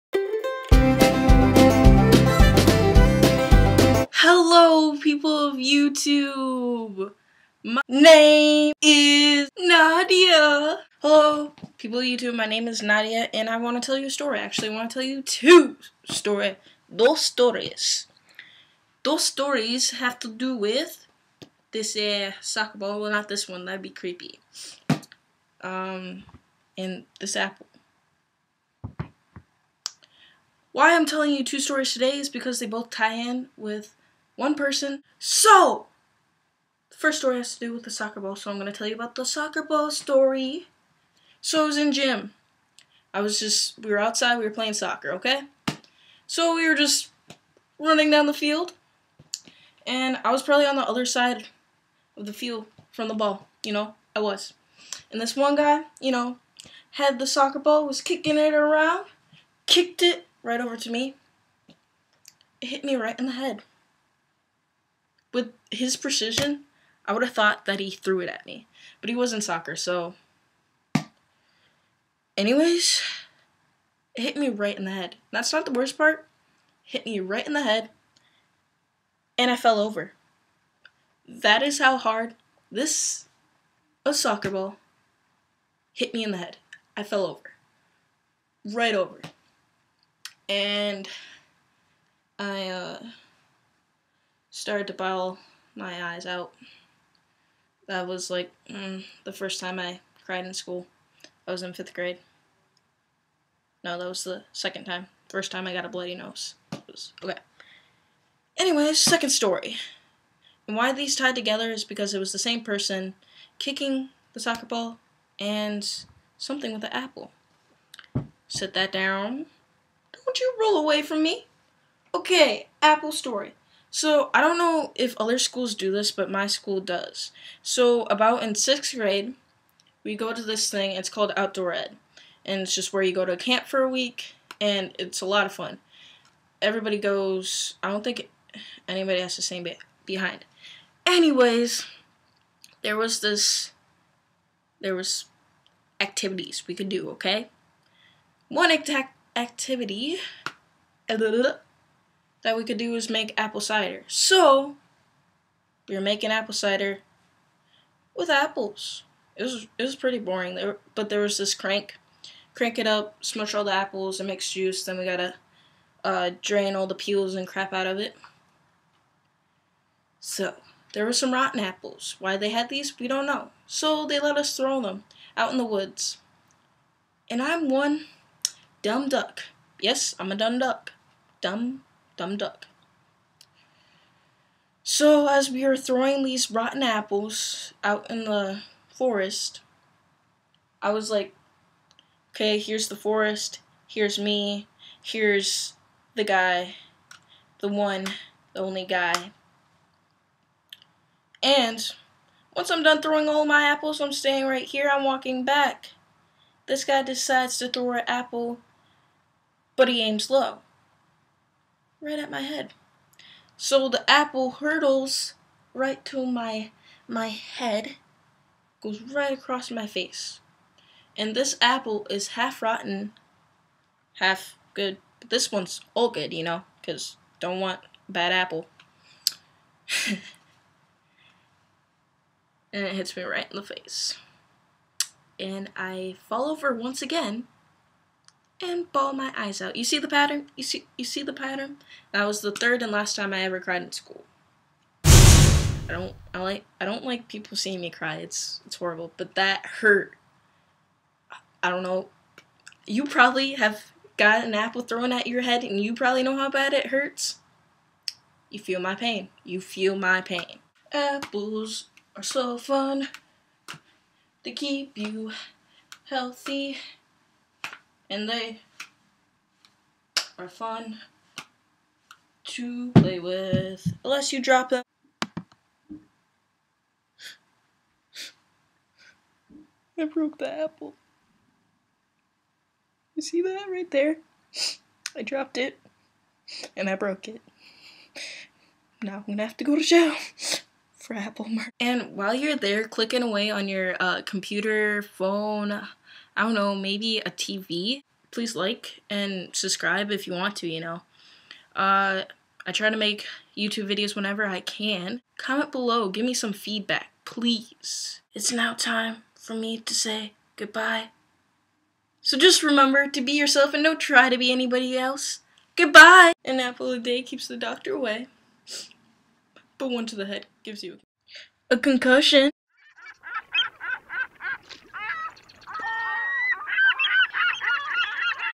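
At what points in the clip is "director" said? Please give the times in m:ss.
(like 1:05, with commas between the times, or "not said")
not said.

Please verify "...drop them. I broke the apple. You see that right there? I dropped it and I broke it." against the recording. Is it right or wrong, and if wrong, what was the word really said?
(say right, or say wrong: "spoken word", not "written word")
right.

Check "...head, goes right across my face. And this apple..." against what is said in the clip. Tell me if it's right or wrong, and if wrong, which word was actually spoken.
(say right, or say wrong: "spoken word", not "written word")
right.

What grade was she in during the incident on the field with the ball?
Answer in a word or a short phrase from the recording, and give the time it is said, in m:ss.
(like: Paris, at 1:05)
Fifth grade, at 1:41.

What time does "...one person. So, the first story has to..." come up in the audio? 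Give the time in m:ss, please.
0:34.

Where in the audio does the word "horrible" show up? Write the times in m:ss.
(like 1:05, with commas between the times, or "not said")
4:08.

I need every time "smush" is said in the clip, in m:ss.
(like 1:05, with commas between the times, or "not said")
2:43.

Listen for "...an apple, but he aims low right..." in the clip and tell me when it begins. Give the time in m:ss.
3:27.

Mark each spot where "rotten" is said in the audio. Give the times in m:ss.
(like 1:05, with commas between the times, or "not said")
2:51, 3:06, 3:42.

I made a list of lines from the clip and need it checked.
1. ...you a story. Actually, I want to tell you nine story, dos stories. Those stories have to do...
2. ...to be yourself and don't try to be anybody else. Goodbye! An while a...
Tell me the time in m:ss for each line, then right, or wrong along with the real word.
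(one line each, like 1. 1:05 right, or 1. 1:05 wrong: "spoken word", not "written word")
1. 0:13 wrong: "two", not "nine"
2. 5:13 wrong: "apple", not "while".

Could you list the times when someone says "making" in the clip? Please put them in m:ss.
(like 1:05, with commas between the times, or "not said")
2:36.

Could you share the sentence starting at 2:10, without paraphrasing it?
It's called outdoor ed, and it's just where you go to camp for a week, and it's a lot of fun.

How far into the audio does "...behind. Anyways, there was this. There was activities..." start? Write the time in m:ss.
2:20.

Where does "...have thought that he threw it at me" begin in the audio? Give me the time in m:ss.
1:07.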